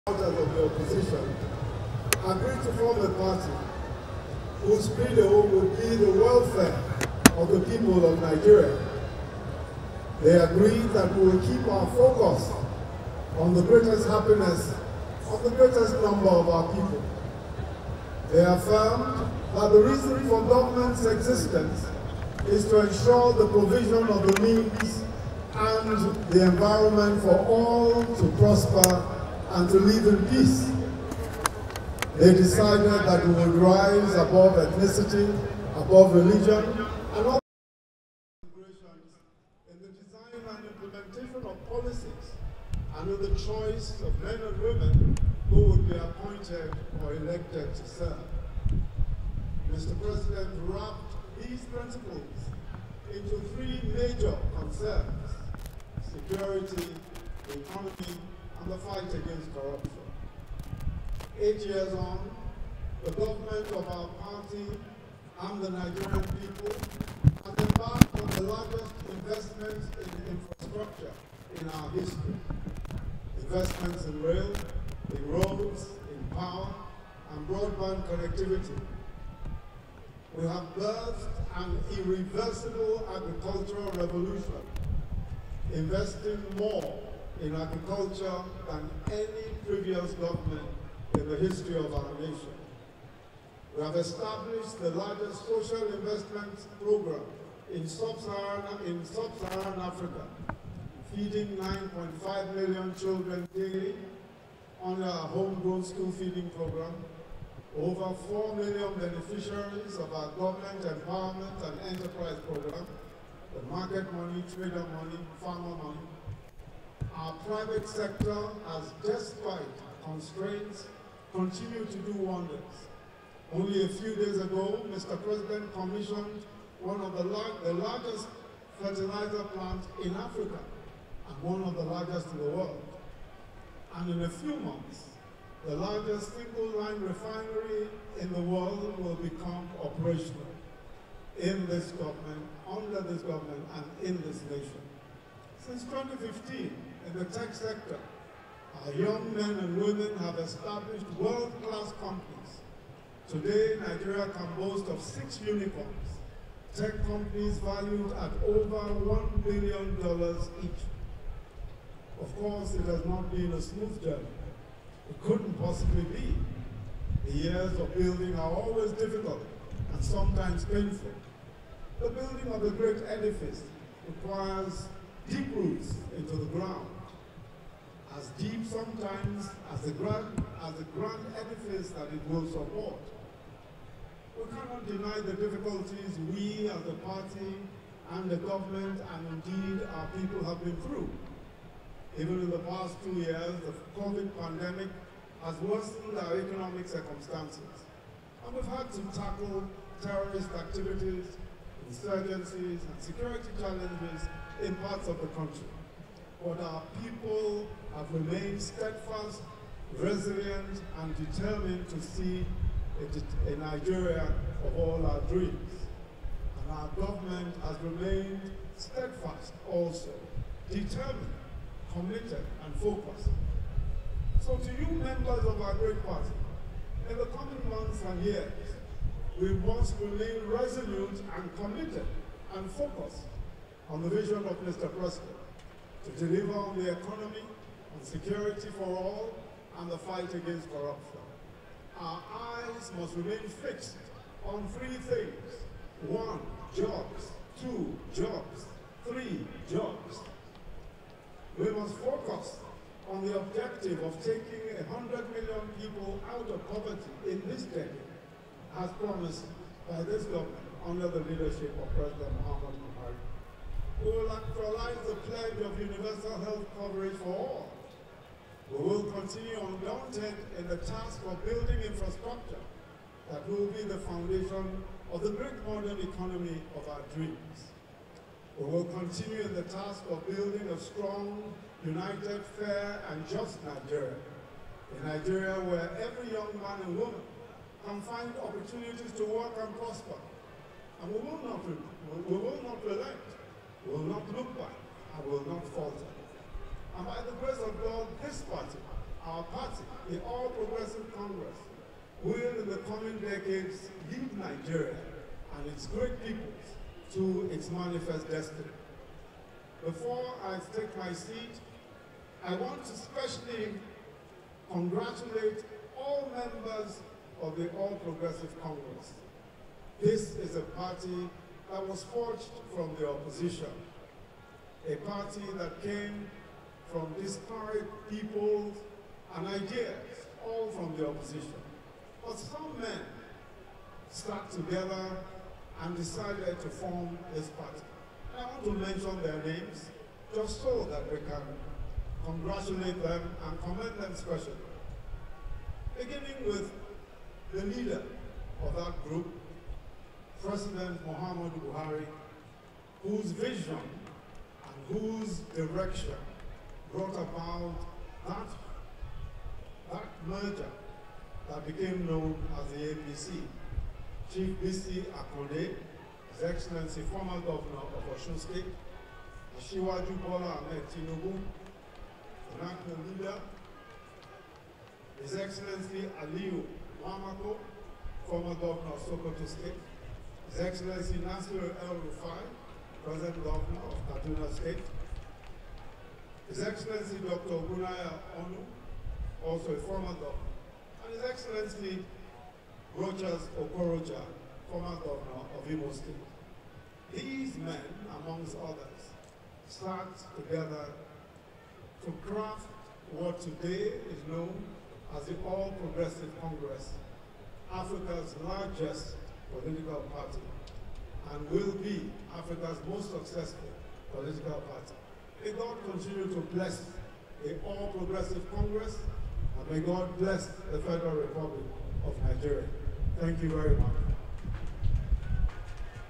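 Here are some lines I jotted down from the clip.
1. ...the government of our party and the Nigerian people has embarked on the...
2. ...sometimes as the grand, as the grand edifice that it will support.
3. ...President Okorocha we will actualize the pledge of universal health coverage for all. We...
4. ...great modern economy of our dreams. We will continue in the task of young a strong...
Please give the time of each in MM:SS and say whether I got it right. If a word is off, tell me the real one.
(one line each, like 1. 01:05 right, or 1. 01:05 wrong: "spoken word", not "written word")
1. 01:03 right
2. 02:58 right
3. 04:21 wrong: "Mohamed", not "Okorocha"
4. 04:35 wrong: "building", not "young".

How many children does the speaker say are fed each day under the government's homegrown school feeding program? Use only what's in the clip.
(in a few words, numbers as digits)
9.5 million.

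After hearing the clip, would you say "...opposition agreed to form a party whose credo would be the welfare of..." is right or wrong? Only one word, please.
right.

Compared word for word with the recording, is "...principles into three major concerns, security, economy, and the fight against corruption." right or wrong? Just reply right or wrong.
right.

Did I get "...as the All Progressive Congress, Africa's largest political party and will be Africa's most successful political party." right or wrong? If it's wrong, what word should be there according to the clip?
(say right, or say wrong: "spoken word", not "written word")
right.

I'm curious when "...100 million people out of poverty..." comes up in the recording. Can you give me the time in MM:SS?
04:14.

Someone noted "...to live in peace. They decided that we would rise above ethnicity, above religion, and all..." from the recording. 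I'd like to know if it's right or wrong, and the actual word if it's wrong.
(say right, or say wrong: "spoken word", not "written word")
right.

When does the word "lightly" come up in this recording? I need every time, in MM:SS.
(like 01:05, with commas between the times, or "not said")
not said.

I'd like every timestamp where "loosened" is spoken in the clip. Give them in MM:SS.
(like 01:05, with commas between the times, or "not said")
not said.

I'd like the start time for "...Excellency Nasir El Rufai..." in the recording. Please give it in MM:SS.
06:20.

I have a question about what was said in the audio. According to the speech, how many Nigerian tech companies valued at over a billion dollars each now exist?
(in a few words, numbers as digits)
6.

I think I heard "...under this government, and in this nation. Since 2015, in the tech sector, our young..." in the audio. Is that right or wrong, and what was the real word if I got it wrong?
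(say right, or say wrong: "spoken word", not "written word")
right.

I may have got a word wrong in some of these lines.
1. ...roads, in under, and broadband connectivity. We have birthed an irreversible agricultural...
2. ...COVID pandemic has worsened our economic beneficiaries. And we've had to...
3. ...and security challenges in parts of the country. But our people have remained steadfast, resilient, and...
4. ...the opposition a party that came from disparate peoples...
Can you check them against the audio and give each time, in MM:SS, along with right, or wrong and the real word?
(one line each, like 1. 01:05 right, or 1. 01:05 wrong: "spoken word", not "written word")
1. 01:15 wrong: "power", not "under"
2. 03:14 wrong: "circumstances", not "beneficiaries"
3. 03:22 right
4. 05:22 right.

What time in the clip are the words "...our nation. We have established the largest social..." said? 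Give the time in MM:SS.
01:31.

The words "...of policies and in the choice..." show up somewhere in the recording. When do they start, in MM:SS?
00:41.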